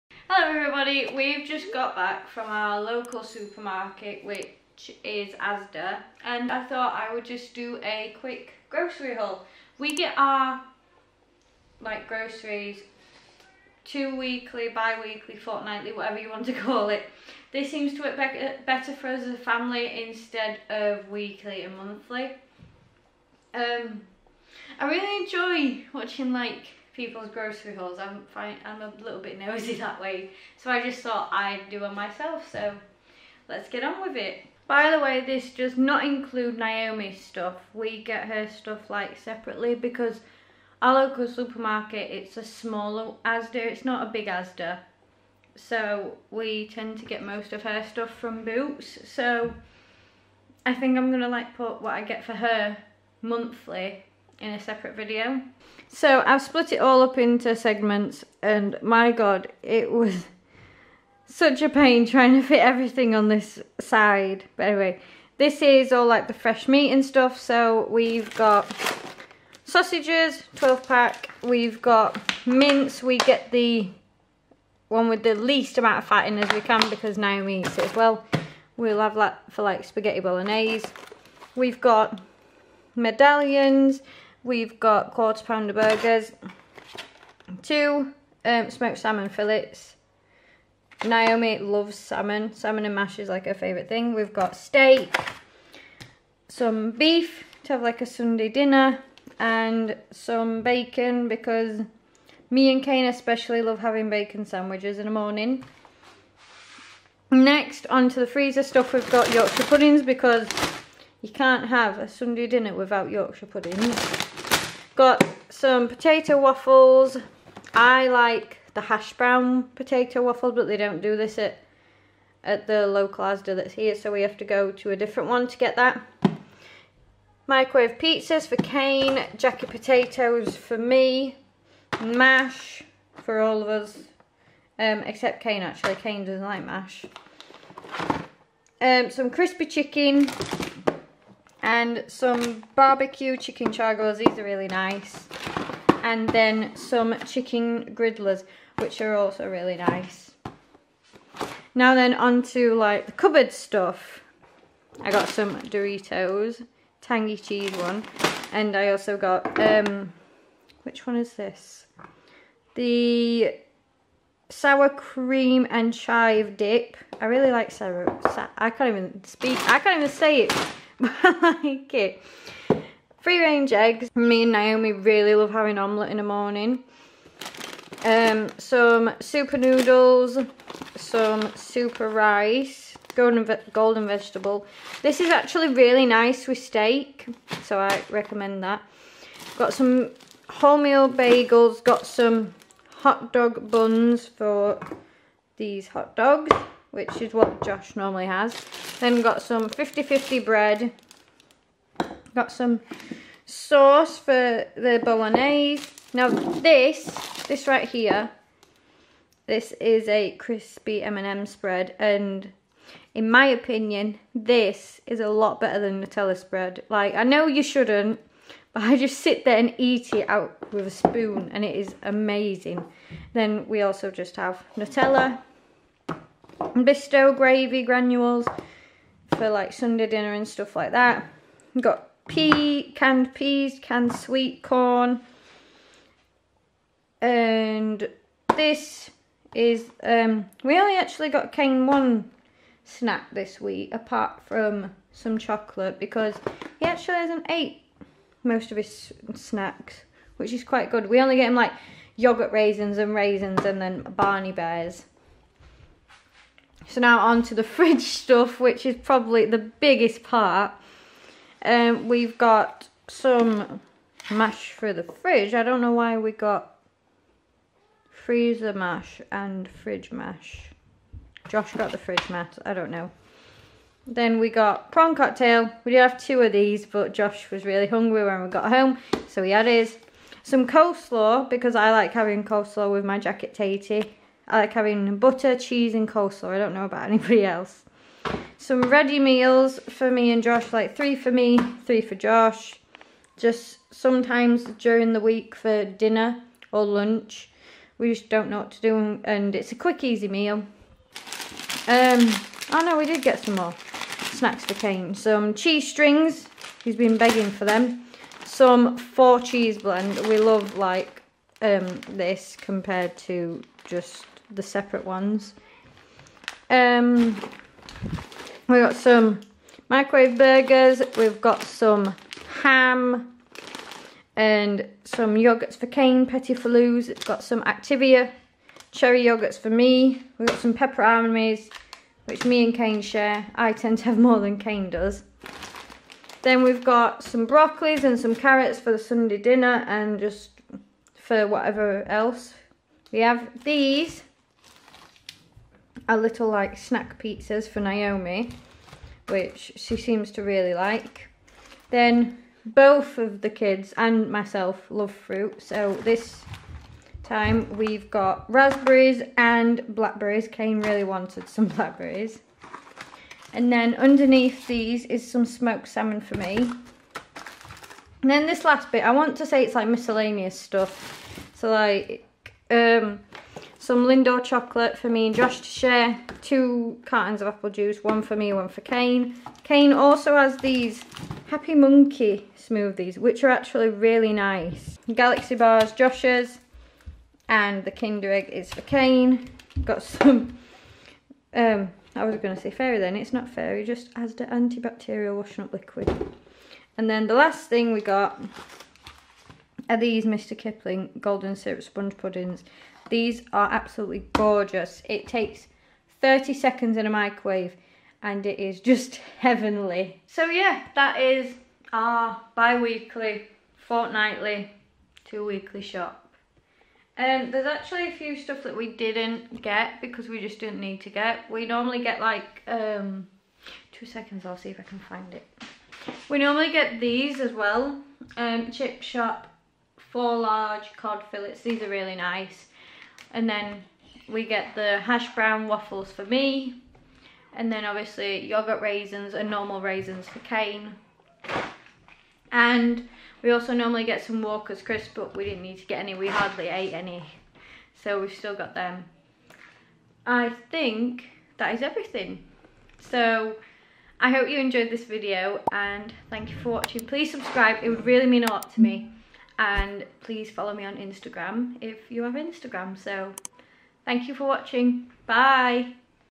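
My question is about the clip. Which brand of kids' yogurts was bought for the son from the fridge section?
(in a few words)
Petit Filous.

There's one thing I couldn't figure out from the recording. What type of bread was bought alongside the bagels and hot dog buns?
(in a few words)
50-50 bread.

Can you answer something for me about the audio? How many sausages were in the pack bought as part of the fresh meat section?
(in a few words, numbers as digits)
12.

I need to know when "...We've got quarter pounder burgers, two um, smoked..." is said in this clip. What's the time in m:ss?
1:24.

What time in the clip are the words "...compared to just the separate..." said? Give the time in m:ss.
5:12.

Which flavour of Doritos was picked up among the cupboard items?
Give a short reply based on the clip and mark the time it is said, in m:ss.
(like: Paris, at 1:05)
Tangy cheese, at 2:37.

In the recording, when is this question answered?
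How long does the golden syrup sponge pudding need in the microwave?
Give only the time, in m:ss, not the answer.
6:46.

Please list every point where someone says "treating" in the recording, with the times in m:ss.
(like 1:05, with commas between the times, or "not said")
not said.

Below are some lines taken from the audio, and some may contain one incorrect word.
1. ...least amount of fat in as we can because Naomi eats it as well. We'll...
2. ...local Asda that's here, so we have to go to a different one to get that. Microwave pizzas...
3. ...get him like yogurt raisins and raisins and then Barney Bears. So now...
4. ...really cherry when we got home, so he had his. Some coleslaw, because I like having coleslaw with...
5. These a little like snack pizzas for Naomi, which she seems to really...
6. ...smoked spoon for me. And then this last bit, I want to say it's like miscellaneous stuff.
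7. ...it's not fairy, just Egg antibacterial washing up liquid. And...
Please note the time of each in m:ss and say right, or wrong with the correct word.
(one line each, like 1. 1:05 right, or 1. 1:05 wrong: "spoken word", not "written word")
1. 1:15 right
2. 2:02 right
3. 4:11 right
4. 4:37 wrong: "hungry", not "cherry"
5. 5:43 right
6. 6:05 wrong: "salmon", not "spoon"
7. 6:33 wrong: "Asda", not "Egg".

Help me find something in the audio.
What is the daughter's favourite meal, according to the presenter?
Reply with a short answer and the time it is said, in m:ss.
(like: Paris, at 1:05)
Salmon and mash, at 1:32.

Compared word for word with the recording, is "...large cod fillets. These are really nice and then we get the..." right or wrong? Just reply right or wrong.
right.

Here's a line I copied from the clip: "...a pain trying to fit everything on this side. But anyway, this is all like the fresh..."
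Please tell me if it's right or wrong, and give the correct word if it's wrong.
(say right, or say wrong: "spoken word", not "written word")
right.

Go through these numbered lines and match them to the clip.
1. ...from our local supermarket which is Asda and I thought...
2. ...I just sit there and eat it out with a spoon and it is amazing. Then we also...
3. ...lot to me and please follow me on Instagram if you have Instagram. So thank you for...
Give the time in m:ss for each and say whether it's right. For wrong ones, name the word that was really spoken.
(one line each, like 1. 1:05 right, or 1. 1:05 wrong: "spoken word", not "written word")
1. 0:02 right
2. 3:38 right
3. 7:38 right.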